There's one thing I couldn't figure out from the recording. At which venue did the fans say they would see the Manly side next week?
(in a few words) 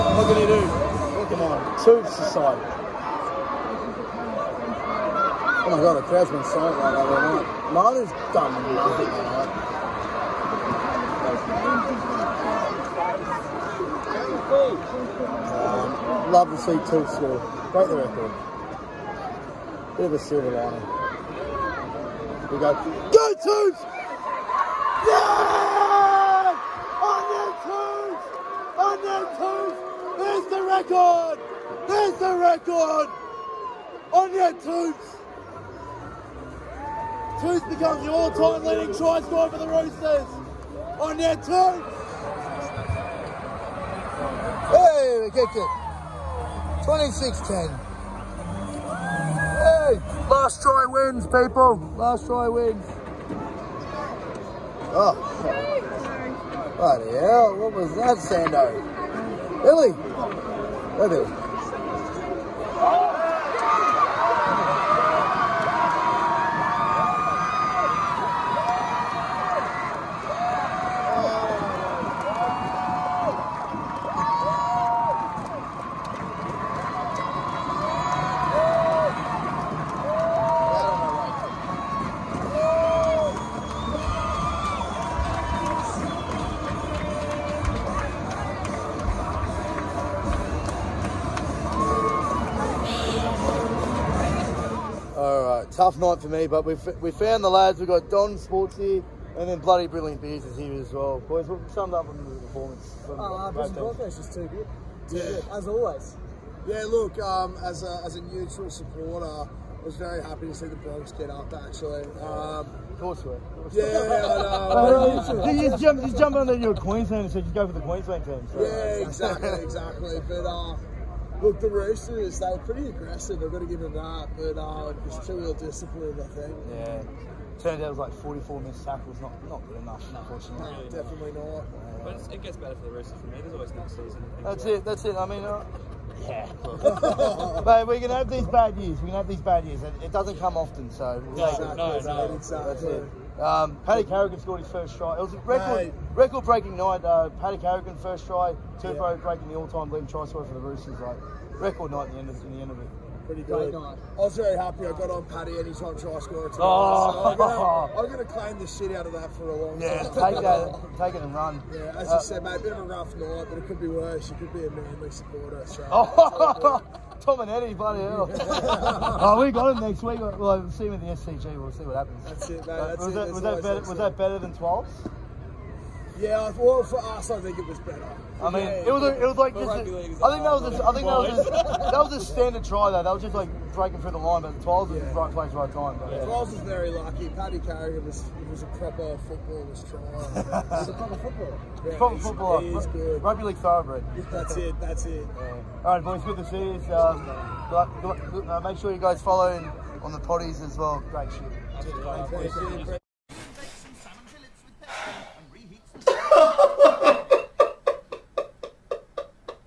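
SCG.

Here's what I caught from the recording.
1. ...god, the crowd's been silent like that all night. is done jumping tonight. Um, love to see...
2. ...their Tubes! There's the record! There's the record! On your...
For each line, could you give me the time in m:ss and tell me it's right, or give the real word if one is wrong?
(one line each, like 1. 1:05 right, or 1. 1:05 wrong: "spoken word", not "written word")
1. 0:05 wrong: "nothing", not "jumping"
2. 0:29 right.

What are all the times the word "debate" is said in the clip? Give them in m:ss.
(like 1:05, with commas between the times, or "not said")
not said.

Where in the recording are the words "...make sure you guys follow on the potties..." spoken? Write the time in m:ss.
3:18.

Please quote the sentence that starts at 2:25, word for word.
It was a record, breaking night.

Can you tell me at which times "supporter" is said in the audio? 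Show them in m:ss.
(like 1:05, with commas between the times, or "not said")
1:48, 2:45.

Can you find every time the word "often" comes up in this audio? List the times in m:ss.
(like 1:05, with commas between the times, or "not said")
2:20.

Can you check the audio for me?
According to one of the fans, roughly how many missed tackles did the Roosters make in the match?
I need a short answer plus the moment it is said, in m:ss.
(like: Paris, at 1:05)
44, at 2:08.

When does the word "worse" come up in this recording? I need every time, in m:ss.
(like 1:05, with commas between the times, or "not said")
2:43.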